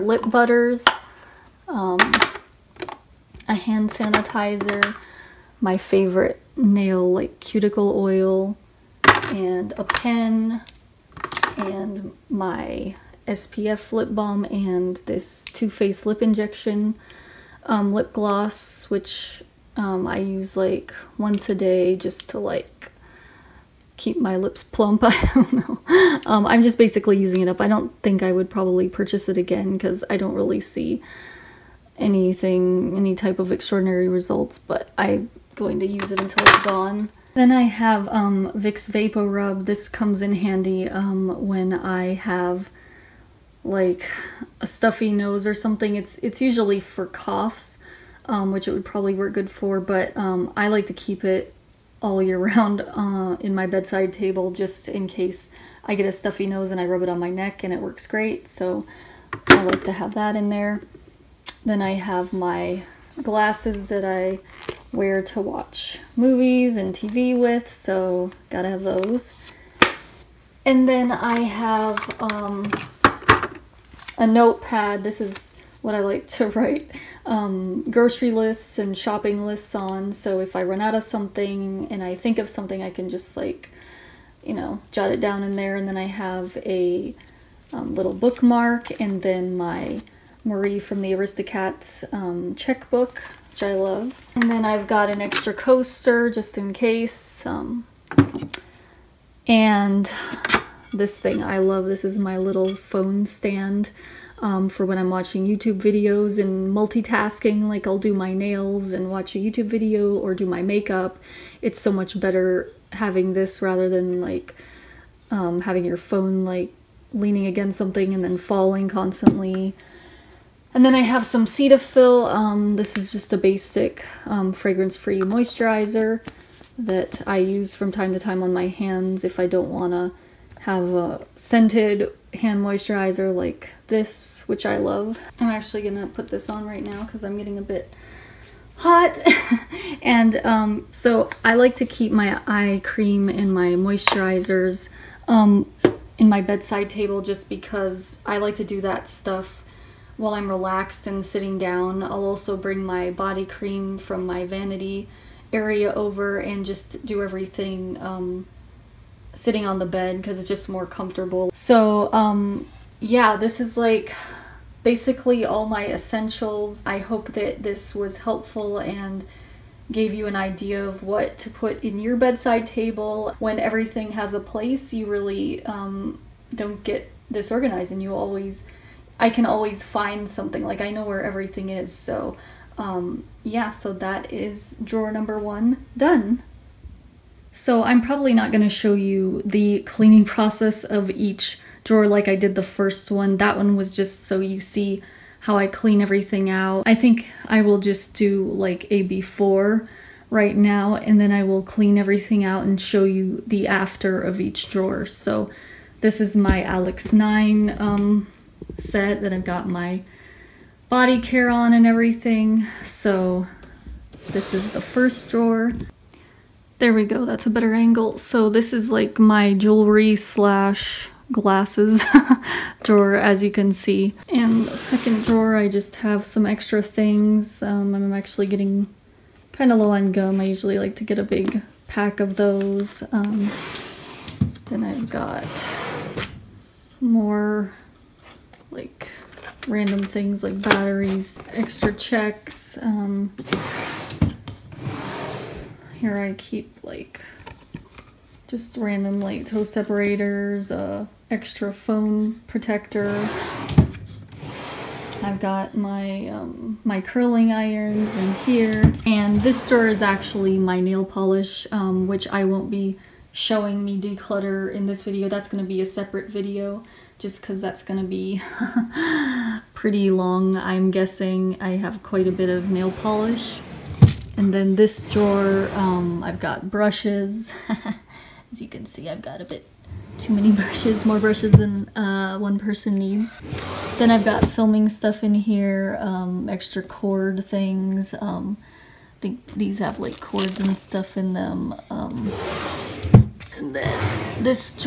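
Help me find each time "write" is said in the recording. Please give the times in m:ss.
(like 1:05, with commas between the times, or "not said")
1:16.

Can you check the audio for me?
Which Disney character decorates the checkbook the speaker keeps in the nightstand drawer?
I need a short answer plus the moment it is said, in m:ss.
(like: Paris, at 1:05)
Marie, at 1:30.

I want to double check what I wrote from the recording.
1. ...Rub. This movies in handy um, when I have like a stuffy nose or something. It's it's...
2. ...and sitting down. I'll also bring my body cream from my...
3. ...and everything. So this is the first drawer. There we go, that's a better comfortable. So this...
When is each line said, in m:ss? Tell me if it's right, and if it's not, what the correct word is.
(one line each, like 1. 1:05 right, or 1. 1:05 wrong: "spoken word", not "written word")
1. 0:39 wrong: "comes", not "movies"
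2. 2:31 right
3. 3:31 wrong: "angle", not "comfortable".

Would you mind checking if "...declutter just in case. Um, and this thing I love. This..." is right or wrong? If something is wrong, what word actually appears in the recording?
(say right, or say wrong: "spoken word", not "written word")
wrong: "coaster", not "declutter".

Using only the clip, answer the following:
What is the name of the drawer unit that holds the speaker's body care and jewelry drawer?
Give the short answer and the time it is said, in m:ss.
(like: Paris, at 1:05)
Alex 9, at 3:26.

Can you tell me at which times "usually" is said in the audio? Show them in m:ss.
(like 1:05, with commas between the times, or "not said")
0:46, 3:50.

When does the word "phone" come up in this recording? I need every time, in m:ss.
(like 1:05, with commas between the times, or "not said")
1:42, 1:55, 4:11.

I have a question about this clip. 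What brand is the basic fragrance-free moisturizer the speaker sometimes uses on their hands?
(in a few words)
Cetaphil.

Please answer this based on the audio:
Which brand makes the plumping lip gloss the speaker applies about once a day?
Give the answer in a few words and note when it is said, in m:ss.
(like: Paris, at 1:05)
Too Faced, at 0:15.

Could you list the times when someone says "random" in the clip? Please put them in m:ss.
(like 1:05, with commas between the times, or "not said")
3:59, 4:08.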